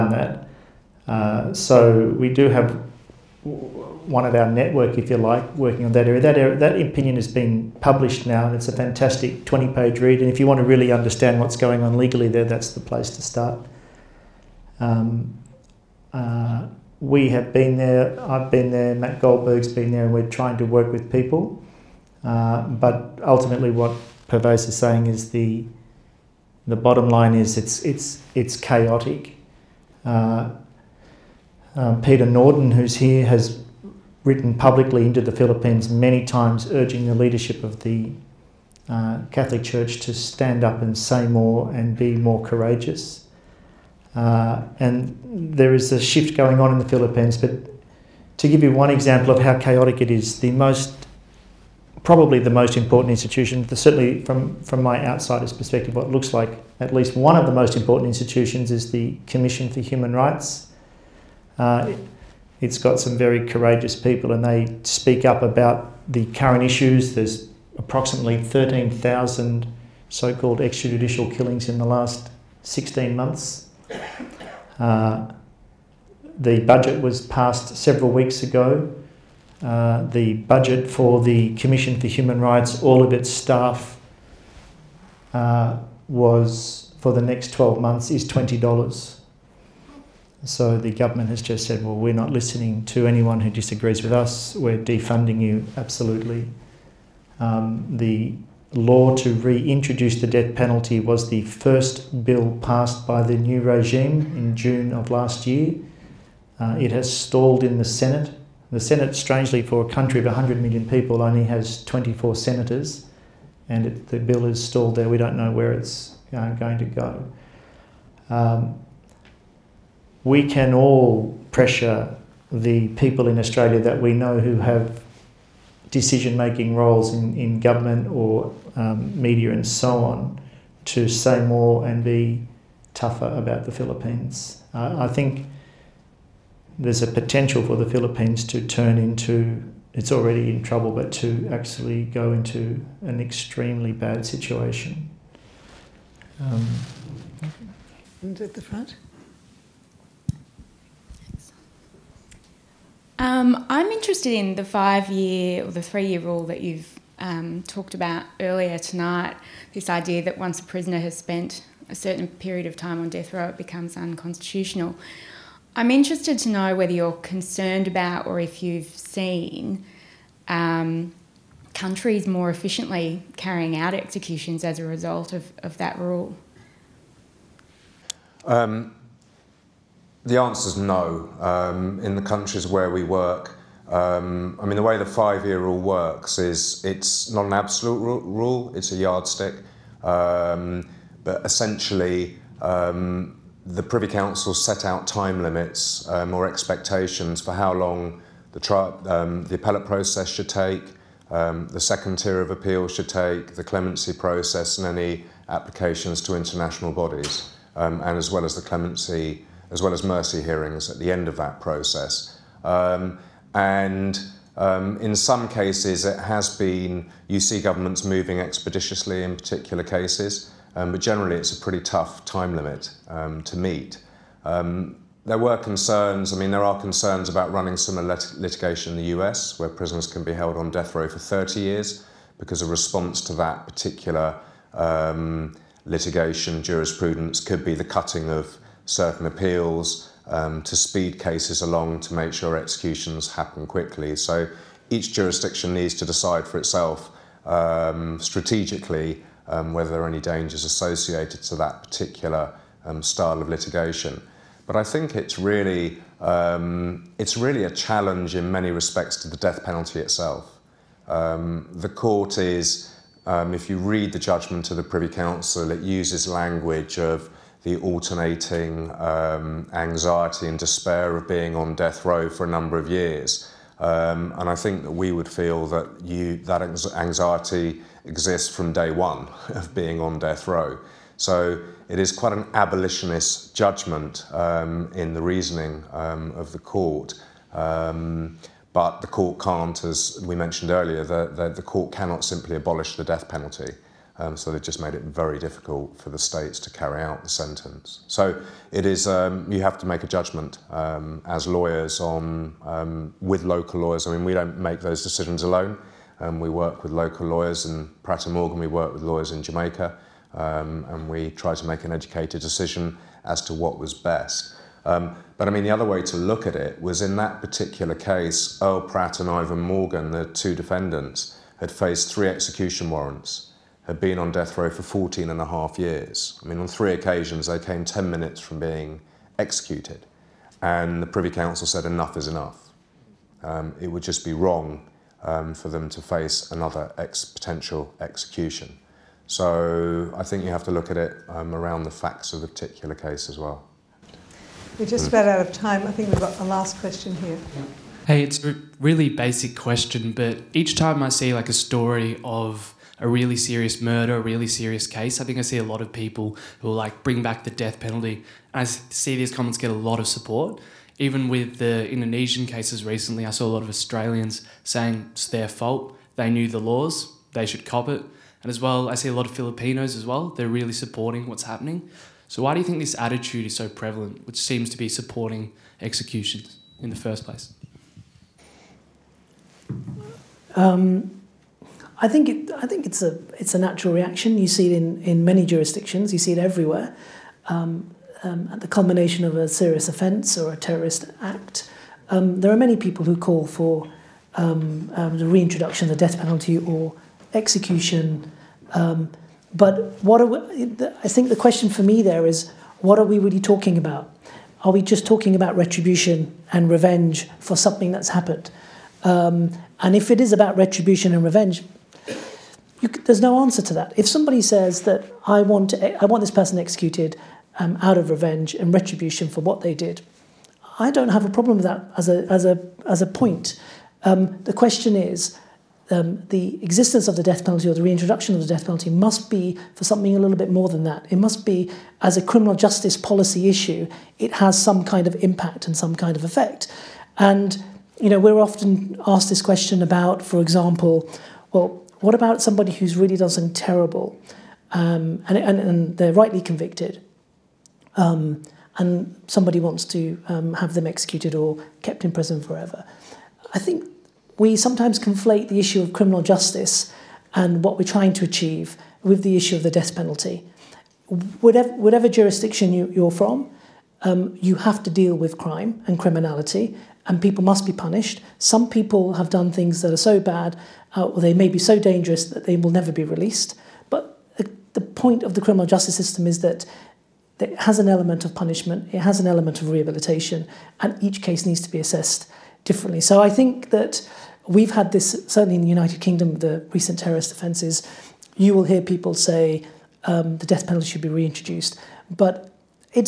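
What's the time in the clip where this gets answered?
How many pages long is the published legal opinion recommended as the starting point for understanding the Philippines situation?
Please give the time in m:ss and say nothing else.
0:09.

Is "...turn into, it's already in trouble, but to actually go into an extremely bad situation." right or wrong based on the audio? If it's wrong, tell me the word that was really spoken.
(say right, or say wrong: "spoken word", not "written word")
right.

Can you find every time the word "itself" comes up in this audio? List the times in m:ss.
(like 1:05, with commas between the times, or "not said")
4:06, 4:19.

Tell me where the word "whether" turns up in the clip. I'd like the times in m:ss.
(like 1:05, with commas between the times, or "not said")
2:46, 4:09.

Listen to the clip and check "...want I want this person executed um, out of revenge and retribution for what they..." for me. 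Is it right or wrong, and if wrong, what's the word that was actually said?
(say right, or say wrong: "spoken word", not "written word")
right.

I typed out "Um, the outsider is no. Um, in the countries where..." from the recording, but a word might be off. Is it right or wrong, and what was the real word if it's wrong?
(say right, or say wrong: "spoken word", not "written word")
wrong: "answer", not "outsider".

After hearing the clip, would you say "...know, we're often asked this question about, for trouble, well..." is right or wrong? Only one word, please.
wrong.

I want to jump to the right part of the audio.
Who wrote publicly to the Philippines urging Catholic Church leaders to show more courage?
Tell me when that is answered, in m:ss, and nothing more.
0:32.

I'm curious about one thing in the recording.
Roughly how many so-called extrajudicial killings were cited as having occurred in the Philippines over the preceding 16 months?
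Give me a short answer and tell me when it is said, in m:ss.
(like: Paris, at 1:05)
13,000, at 1:08.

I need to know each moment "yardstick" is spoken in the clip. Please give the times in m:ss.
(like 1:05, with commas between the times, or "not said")
3:08.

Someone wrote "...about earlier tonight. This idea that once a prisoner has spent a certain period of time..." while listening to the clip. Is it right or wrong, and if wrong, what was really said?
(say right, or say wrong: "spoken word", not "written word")
right.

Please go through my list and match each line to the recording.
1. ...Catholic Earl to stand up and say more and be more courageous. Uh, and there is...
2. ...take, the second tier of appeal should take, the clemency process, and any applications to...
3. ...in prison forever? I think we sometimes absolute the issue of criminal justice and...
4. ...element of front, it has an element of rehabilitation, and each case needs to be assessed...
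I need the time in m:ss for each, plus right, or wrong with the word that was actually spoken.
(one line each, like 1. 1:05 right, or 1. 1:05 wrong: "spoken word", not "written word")
1. 0:39 wrong: "Church", not "Earl"
2. 3:20 right
3. 7:32 wrong: "conflate", not "absolute"
4. 7:57 wrong: "punishment", not "front".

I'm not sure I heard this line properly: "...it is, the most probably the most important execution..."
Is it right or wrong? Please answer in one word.
wrong.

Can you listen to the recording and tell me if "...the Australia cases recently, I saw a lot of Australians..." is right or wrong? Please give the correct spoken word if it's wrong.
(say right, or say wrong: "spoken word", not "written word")
wrong: "Indonesian", not "Australia".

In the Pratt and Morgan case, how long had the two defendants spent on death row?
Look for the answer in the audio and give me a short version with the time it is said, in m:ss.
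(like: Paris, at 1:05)
14 and a half years, at 5:24.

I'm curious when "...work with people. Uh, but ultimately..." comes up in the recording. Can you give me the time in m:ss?
0:20.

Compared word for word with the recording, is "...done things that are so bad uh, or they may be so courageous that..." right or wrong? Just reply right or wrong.
wrong.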